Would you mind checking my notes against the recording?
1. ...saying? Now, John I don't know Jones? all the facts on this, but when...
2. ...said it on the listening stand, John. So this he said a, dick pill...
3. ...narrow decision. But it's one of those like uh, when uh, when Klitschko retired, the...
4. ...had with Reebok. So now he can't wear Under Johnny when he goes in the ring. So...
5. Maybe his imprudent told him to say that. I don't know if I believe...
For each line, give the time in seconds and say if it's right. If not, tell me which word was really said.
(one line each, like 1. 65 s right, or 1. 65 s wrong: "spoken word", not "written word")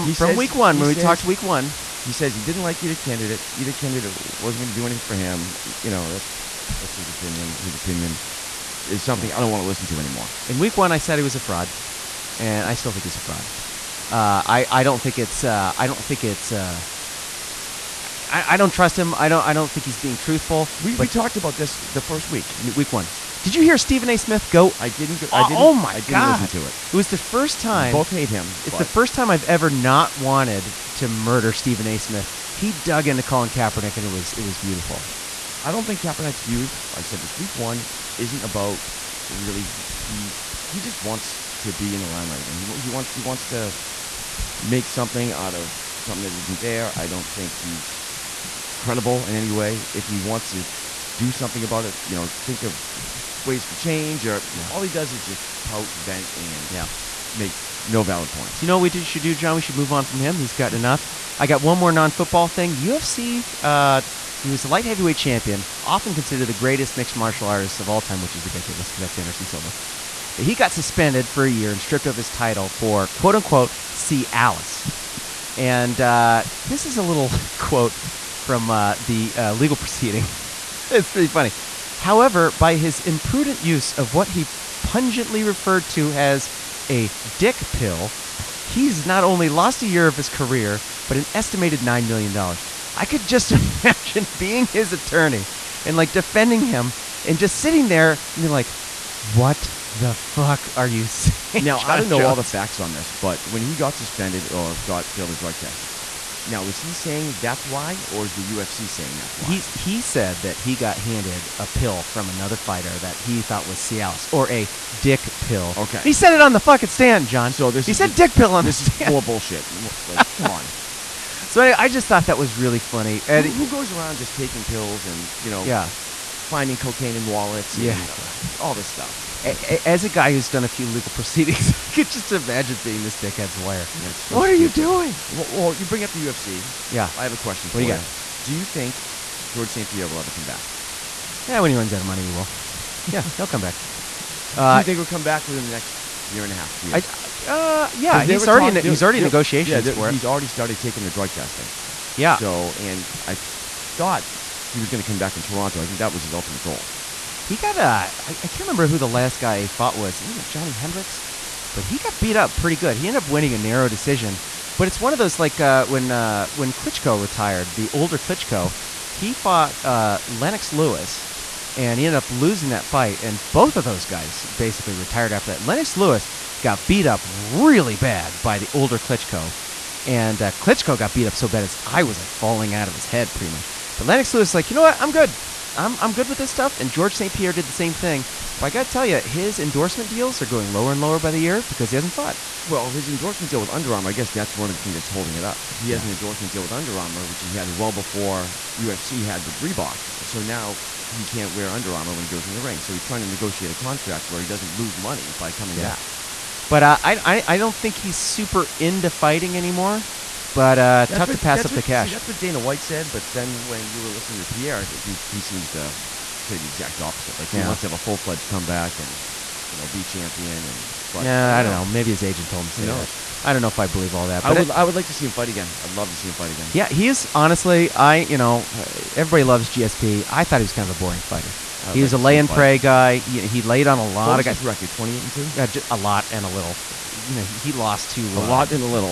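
1. 101 s right
2. 116 s wrong: "fucking", not "listening"
3. 163 s right
4. 199 s wrong: "Armour", not "Johnny"
5. 221 s wrong: "agent", not "imprudent".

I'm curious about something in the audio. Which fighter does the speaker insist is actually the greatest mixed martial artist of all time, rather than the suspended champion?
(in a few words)
Anderson Silva.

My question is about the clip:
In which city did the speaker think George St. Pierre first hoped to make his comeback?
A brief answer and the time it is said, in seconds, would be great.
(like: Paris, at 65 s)
Toronto, at 155 s.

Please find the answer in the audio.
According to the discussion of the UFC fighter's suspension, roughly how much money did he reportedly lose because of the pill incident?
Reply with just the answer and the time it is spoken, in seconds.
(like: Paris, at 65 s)
$9 million, at 91 s.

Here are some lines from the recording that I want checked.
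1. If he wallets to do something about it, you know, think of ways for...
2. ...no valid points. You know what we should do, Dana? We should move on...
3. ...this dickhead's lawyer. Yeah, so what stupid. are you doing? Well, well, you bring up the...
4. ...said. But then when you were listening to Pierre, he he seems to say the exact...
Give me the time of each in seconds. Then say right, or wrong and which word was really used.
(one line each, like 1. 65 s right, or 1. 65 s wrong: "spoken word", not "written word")
1. 49 s wrong: "wants", not "wallets"
2. 57 s wrong: "John", not "Dana"
3. 133 s right
4. 212 s right.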